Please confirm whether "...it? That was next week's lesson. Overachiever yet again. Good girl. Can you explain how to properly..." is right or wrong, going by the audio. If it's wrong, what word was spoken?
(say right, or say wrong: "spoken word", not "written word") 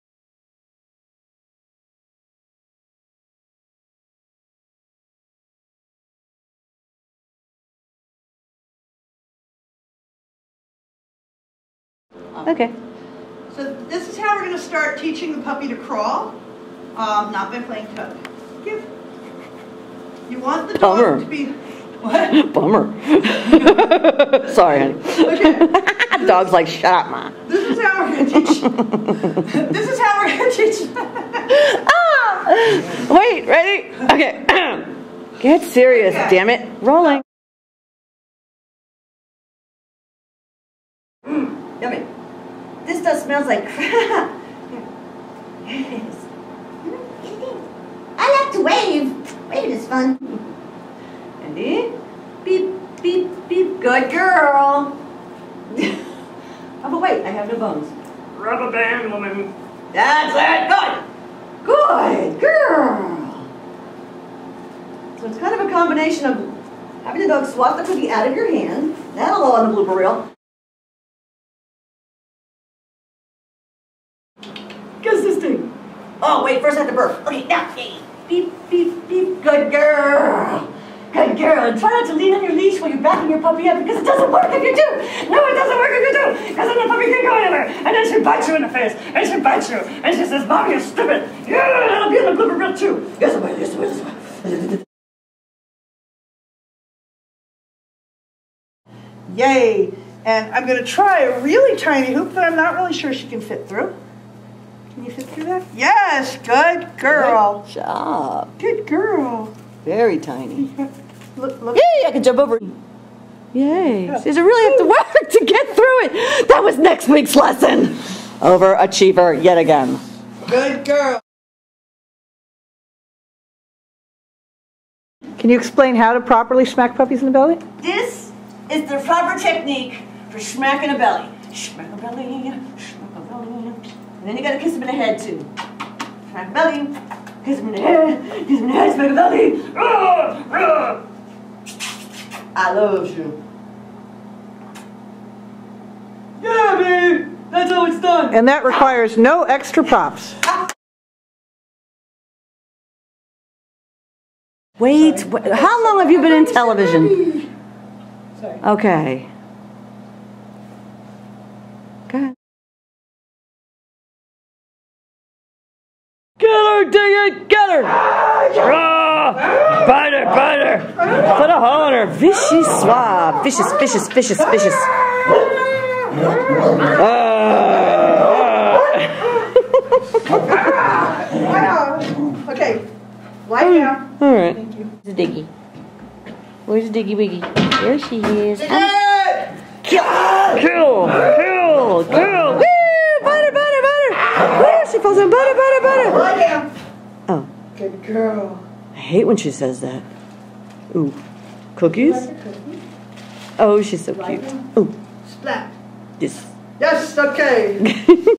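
right.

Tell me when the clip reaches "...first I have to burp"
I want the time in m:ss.
1:16.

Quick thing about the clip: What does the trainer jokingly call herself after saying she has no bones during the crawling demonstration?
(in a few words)
Rubber band woman.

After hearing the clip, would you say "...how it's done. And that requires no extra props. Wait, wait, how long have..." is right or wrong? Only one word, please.
right.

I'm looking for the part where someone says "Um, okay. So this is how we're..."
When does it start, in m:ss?
0:12.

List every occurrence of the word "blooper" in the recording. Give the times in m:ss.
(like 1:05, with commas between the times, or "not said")
1:09, 1:32.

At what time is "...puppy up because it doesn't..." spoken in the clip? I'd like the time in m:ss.
1:23.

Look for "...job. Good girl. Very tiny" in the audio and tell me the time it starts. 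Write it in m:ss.
1:47.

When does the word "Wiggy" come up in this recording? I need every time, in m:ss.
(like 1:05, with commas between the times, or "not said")
3:07.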